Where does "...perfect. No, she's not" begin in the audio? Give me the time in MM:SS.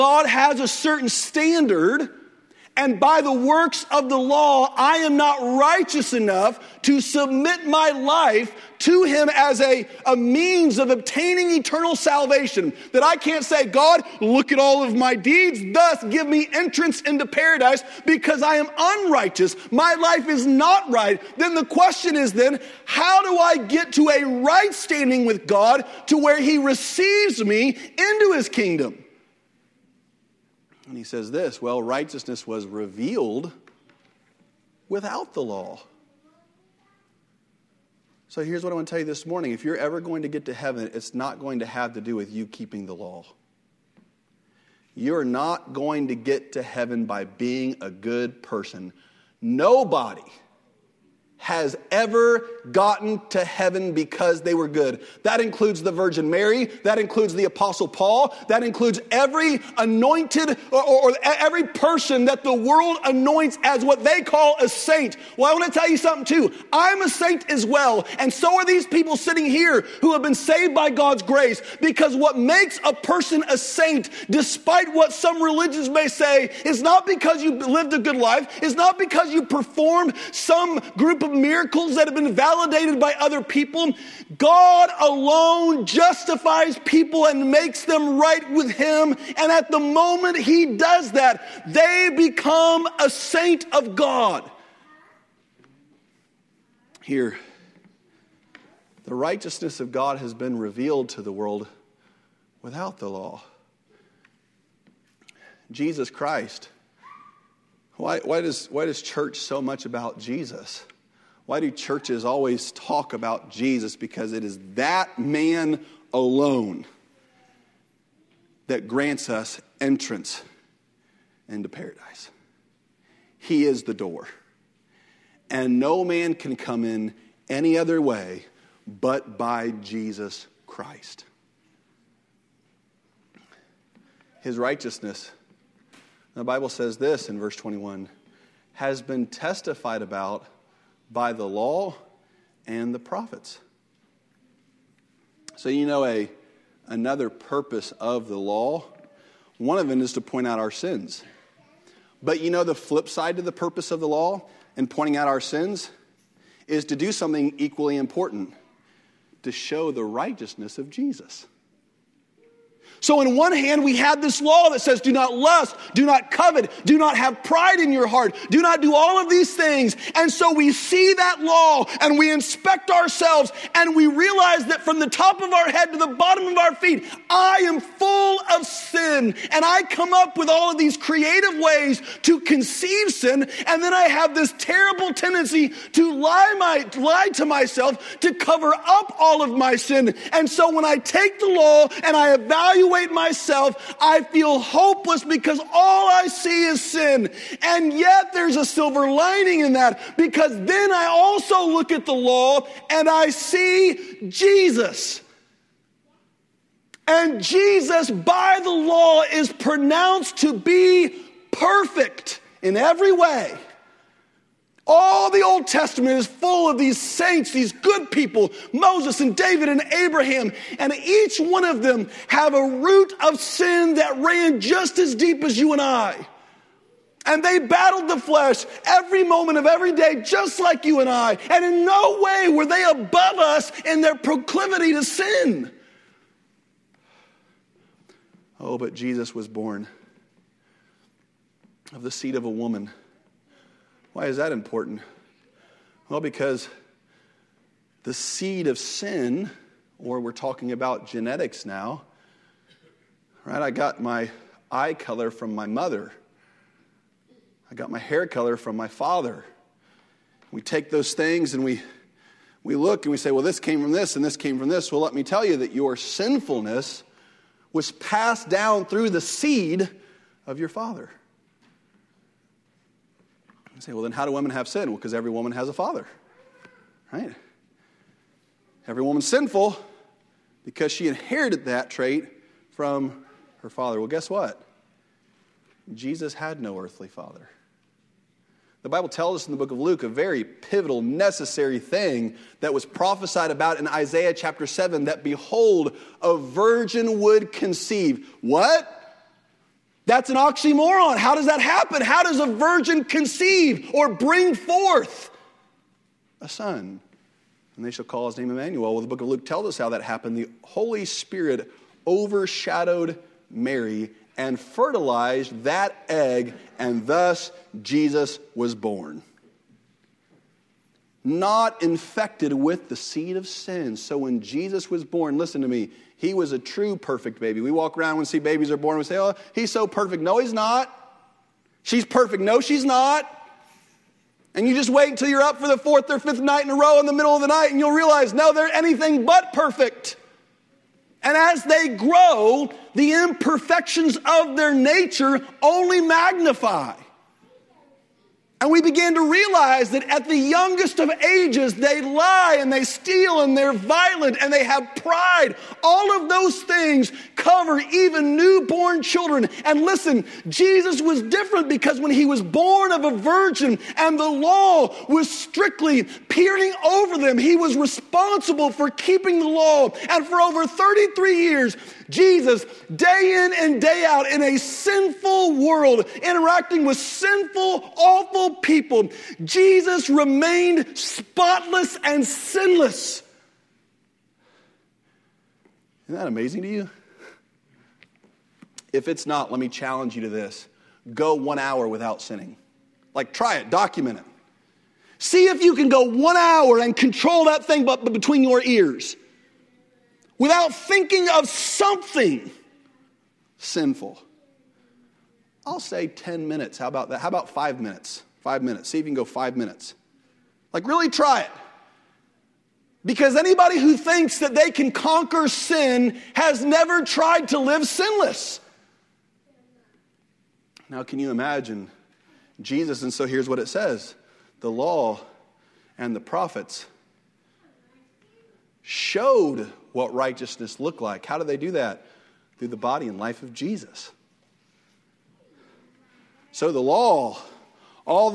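05:32.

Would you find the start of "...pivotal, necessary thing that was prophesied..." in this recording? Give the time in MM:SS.
04:50.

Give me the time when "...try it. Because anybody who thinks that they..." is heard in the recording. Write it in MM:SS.
06:51.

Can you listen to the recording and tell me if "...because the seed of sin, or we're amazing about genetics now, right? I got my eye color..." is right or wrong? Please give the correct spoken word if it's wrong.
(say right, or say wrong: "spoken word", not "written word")
wrong: "talking", not "amazing".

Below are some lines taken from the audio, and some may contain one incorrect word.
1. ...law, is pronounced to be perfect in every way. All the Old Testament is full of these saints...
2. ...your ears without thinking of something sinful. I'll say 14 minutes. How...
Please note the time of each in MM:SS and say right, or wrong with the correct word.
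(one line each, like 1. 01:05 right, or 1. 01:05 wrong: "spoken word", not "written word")
1. 03:28 right
2. 06:38 wrong: "10", not "14".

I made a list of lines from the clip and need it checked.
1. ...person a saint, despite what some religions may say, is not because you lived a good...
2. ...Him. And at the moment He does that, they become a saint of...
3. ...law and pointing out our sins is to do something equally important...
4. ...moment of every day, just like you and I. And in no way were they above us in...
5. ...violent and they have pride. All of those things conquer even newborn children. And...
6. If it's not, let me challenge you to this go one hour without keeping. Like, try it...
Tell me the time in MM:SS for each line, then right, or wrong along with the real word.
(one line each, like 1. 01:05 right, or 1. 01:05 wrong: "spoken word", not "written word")
1. 01:12 right
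2. 01:28 right
3. 02:34 right
4. 03:49 right
5. 05:53 wrong: "cover", not "conquer"
6. 06:28 wrong: "sinning", not "keeping".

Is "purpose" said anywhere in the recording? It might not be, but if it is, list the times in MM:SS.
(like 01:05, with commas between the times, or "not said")
02:27, 02:33.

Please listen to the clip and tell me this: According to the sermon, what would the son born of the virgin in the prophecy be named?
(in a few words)
Emmanuel.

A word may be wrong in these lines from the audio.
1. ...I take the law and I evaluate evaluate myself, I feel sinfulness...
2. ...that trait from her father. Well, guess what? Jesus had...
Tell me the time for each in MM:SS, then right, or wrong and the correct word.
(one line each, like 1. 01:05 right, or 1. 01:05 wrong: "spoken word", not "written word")
1. 03:10 wrong: "hopeless", not "sinfulness"
2. 04:41 right.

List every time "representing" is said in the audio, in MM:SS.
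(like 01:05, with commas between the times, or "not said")
not said.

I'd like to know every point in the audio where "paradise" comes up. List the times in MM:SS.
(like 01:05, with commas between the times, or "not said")
00:17, 02:01.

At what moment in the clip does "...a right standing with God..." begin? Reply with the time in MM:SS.
00:24.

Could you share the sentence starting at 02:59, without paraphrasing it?
And I come up with all of these creative ways to conceive sin.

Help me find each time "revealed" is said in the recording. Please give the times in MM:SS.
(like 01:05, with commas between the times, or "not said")
00:32, 01:40.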